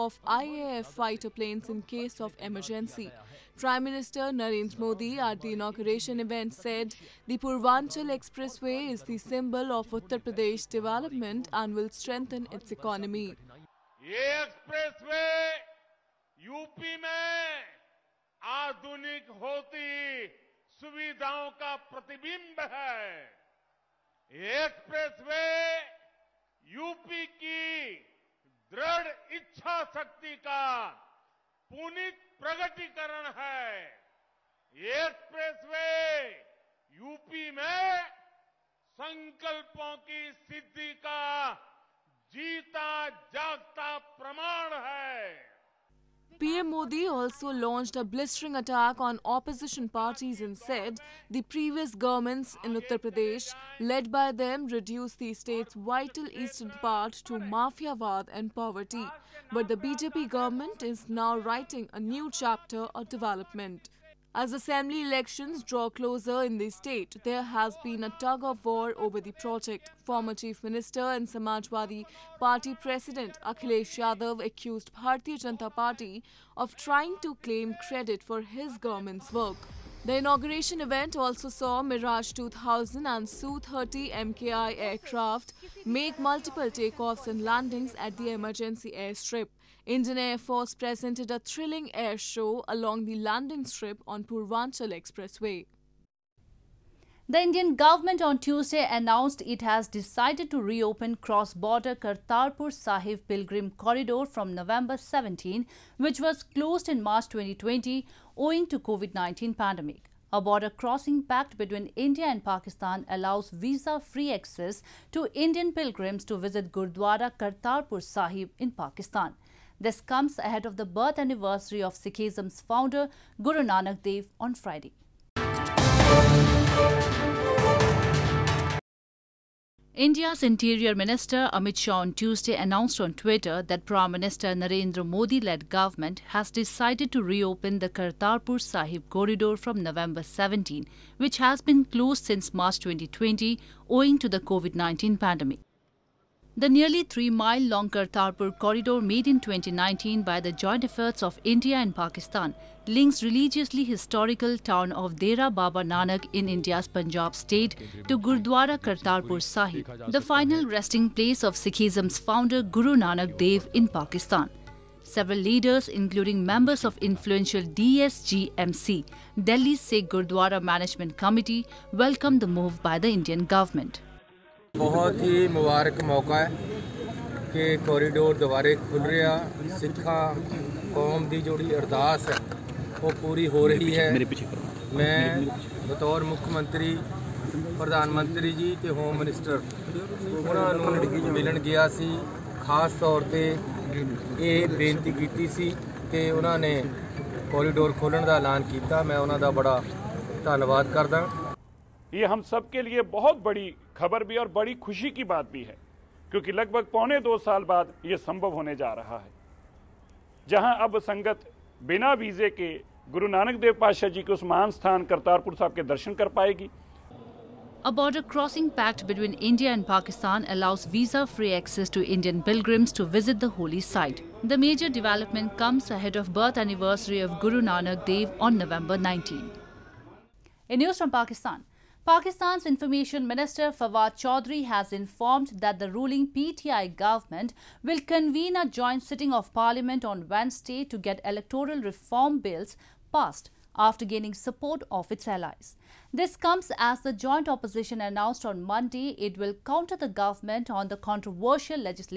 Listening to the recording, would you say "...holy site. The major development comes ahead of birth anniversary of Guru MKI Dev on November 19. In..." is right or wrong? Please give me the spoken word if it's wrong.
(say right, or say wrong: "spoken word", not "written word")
wrong: "Nanak", not "MKI".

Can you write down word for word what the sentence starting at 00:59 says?
But the BJP government is now writing a new chapter of development.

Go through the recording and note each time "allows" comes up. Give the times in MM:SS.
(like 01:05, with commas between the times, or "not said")
01:53, 03:40.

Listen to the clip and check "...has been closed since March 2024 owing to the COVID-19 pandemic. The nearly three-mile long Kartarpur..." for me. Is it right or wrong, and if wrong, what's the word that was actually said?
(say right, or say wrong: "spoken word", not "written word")
wrong: "2020", not "2024".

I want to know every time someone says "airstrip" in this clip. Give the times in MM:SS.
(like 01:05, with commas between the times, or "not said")
01:28.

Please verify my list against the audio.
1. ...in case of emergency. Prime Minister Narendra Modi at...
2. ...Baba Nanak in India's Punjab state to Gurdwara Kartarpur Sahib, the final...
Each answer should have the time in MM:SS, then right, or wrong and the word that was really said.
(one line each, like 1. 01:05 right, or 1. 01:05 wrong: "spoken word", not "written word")
1. 00:01 right
2. 02:35 right.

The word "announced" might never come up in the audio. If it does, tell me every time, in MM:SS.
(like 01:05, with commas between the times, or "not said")
01:38, 02:12, 04:08.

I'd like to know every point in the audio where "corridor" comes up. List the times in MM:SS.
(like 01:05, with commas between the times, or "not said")
01:43, 02:19, 02:28.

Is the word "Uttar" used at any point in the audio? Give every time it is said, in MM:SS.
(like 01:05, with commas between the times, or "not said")
00:09, 00:52.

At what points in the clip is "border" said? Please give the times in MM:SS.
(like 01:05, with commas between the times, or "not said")
01:41, 01:50, 03:37.